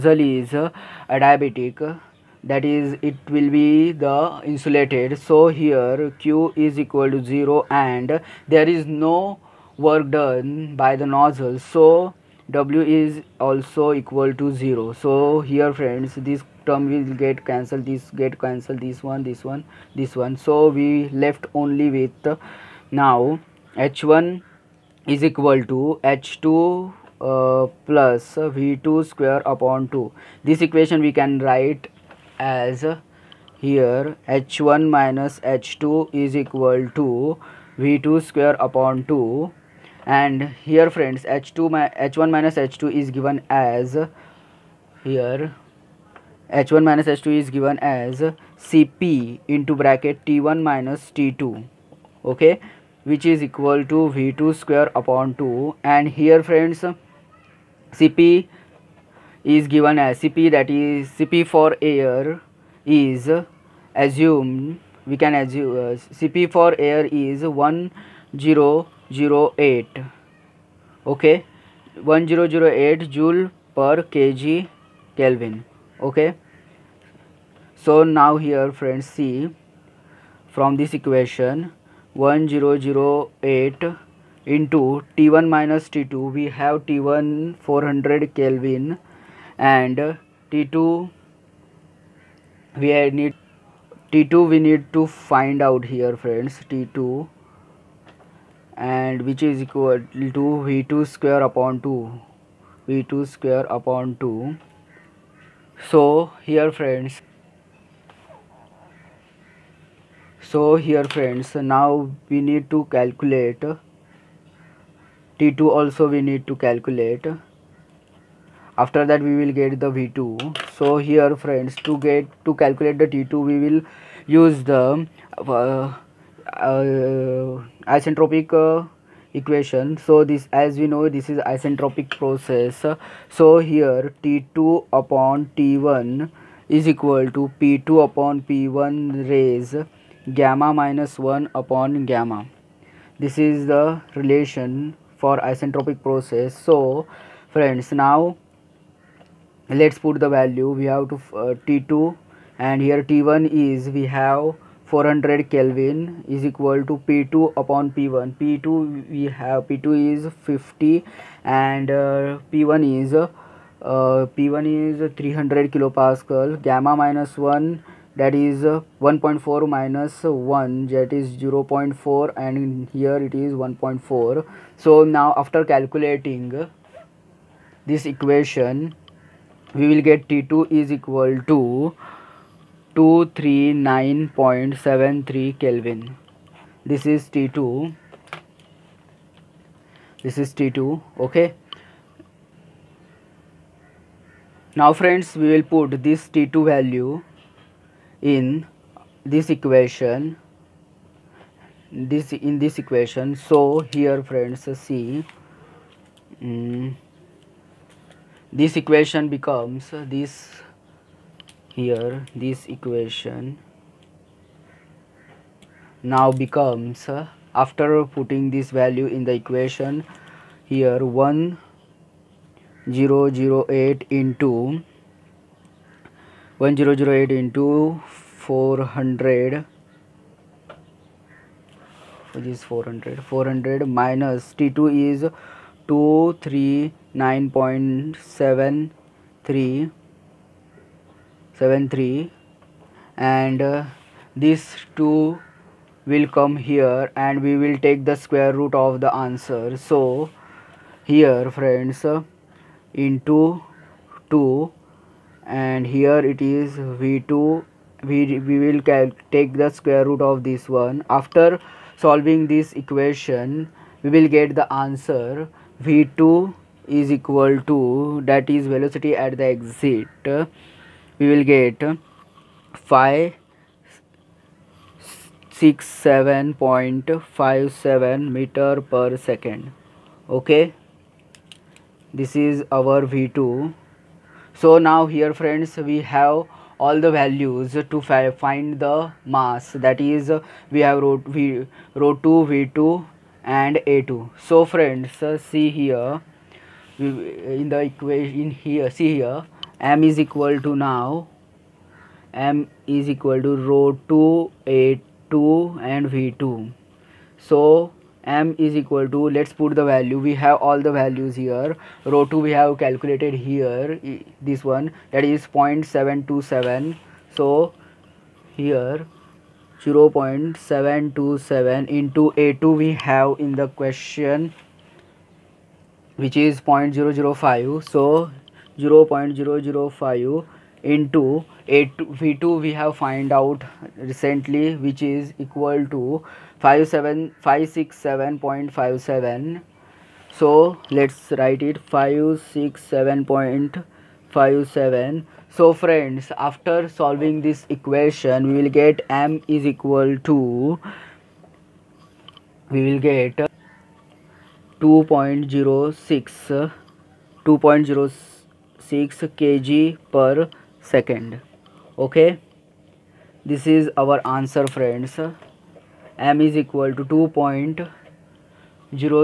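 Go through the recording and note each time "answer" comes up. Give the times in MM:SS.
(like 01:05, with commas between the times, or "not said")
04:09, 04:24, 06:04.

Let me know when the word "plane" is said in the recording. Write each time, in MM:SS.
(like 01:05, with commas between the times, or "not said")
not said.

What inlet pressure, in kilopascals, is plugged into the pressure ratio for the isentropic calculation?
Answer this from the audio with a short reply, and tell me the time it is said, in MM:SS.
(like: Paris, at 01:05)
300 kPa, at 02:45.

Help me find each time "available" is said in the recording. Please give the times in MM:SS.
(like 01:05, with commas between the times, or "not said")
not said.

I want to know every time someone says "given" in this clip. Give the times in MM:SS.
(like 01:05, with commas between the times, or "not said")
00:43, 00:47, 00:59.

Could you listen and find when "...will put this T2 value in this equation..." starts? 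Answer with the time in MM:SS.
03:15.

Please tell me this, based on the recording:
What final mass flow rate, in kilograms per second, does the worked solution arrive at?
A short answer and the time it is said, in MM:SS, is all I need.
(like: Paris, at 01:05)
2.06 kg/s, at 05:57.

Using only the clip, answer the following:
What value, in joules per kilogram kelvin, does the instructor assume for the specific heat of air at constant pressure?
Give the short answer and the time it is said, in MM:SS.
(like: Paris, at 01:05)
1008, at 01:12.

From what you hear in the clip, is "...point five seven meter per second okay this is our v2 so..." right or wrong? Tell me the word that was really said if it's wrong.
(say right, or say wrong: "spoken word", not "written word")
right.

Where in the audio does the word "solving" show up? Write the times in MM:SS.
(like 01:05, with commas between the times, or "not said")
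04:21, 05:47.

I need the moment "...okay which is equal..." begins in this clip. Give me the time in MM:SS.
00:52.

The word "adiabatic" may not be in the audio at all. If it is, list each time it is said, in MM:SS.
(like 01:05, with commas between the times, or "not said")
00:01.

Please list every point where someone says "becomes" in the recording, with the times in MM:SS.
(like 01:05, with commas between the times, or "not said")
03:29, 03:36.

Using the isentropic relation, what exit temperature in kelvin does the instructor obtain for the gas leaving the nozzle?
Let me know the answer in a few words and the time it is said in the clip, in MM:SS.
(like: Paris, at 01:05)
239.73 K, at 03:02.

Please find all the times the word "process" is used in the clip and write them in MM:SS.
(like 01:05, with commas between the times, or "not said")
02:12, 02:26.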